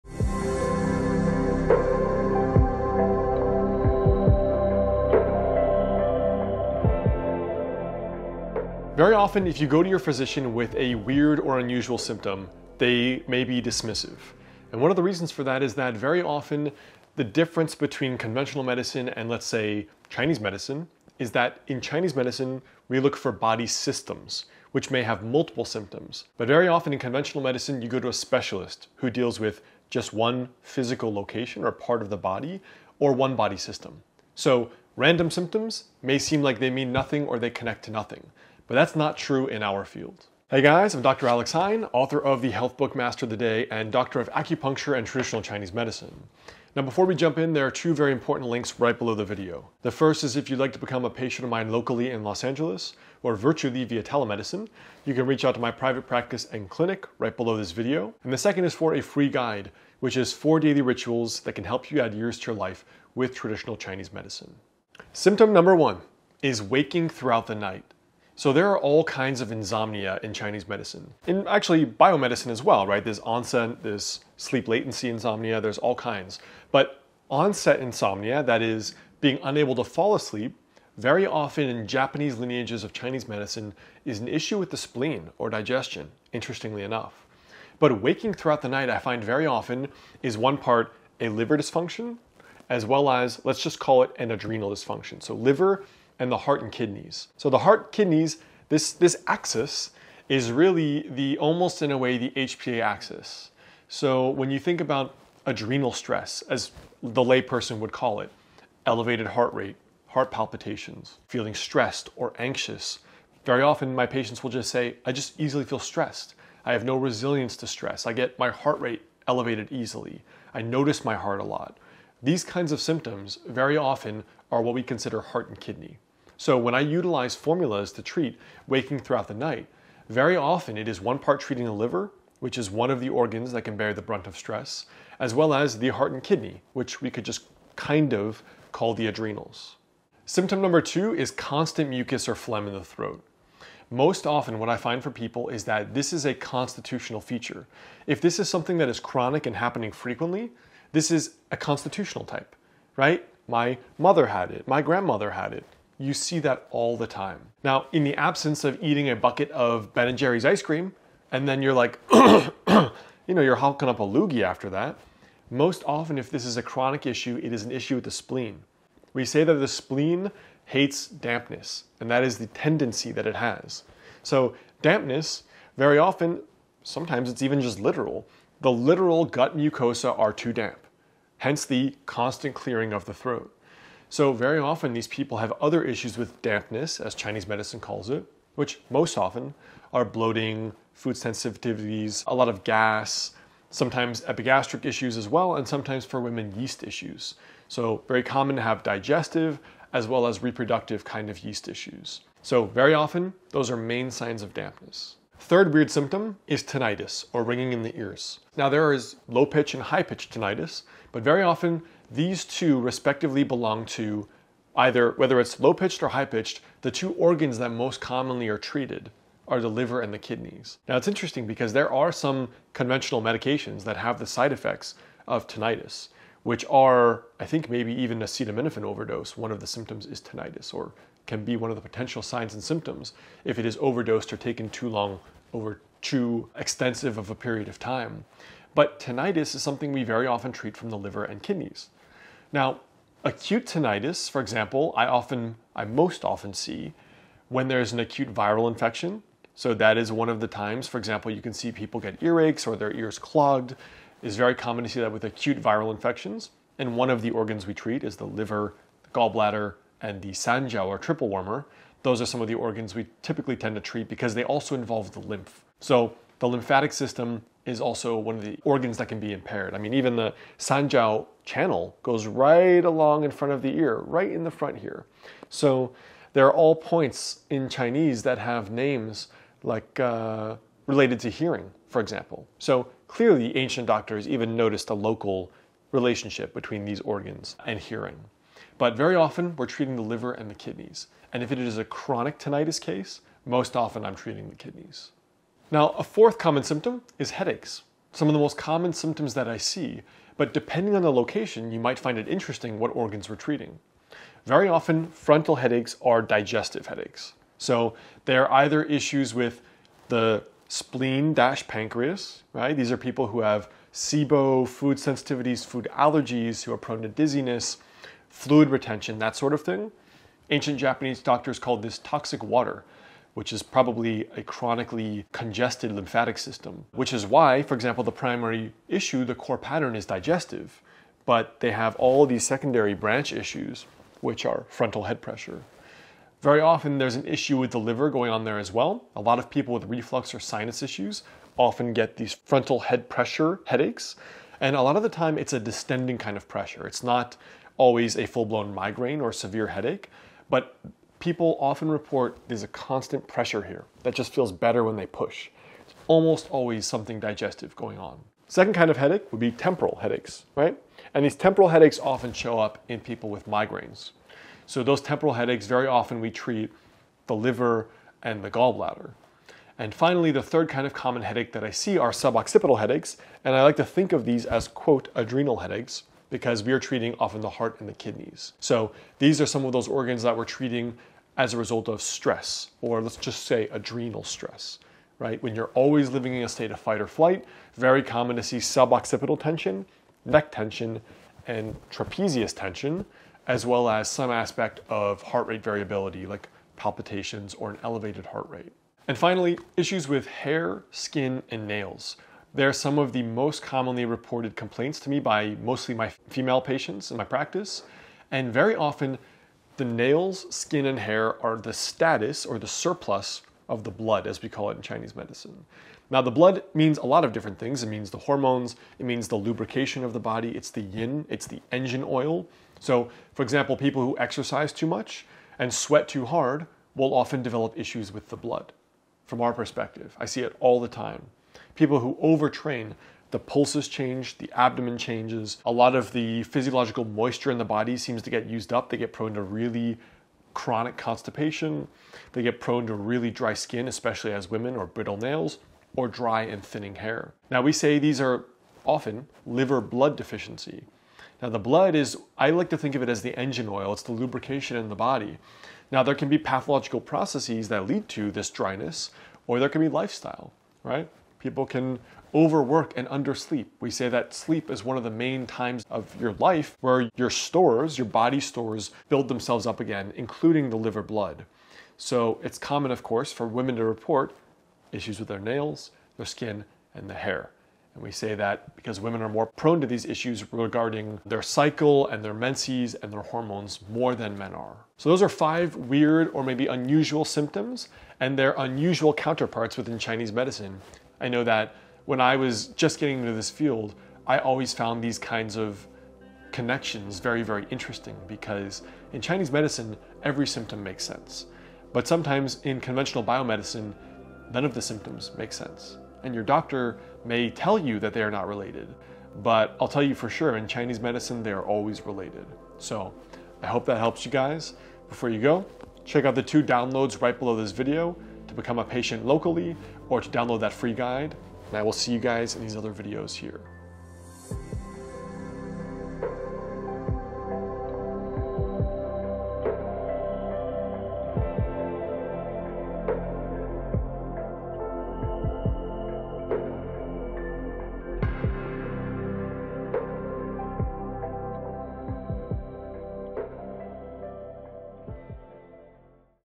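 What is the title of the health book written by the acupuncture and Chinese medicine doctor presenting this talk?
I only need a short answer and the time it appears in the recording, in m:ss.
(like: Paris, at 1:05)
Master of the Day, at 0:42.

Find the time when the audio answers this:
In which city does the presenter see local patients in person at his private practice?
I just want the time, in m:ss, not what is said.
0:52.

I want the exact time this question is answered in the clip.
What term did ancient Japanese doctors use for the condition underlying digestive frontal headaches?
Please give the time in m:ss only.
5:21.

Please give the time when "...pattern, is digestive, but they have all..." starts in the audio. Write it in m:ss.
5:29.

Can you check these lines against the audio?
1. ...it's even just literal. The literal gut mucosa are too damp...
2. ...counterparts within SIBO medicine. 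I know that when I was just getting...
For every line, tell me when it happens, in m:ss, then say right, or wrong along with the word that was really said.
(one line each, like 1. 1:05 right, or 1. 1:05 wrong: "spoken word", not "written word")
1. 2:57 right
2. 8:09 wrong: "Chinese", not "SIBO".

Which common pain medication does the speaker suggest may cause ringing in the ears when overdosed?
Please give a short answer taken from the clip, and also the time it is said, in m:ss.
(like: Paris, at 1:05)
Acetaminophen, at 3:48.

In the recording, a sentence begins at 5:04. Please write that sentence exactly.
Very often, frontal headaches are digestive headaches.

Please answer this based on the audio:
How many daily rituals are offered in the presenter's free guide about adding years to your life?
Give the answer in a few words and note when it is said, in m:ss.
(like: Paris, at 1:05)
4, at 1:00.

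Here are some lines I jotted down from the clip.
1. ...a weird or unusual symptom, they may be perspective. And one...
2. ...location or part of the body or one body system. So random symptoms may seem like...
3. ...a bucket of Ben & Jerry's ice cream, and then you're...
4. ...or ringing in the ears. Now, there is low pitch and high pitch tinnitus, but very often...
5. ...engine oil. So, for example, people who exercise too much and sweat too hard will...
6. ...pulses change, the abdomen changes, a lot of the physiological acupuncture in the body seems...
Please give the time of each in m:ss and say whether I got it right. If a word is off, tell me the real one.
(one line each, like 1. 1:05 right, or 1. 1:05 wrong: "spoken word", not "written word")
1. 0:10 wrong: "dismissive", not "perspective"
2. 0:31 right
3. 2:39 right
4. 3:27 right
5. 7:01 right
6. 7:13 wrong: "moisture", not "acupuncture".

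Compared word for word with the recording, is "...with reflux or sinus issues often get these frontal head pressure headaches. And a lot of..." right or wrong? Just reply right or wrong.
right.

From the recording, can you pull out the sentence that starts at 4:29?
I mean, even the Sanjiao channel goes right along in front of the ear, right in the front here.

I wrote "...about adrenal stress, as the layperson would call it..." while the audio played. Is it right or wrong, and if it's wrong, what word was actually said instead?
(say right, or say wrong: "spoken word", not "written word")
right.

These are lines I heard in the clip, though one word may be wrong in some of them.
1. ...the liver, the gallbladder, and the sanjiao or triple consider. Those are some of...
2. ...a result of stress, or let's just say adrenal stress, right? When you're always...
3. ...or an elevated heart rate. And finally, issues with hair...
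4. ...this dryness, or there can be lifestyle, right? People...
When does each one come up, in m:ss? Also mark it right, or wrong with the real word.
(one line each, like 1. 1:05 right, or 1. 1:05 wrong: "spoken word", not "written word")
1. 4:18 wrong: "warmer", not "consider"
2. 6:21 right
3. 6:37 right
4. 7:38 right.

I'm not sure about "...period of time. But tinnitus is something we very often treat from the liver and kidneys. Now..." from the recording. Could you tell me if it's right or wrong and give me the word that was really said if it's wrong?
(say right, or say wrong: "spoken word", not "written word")
right.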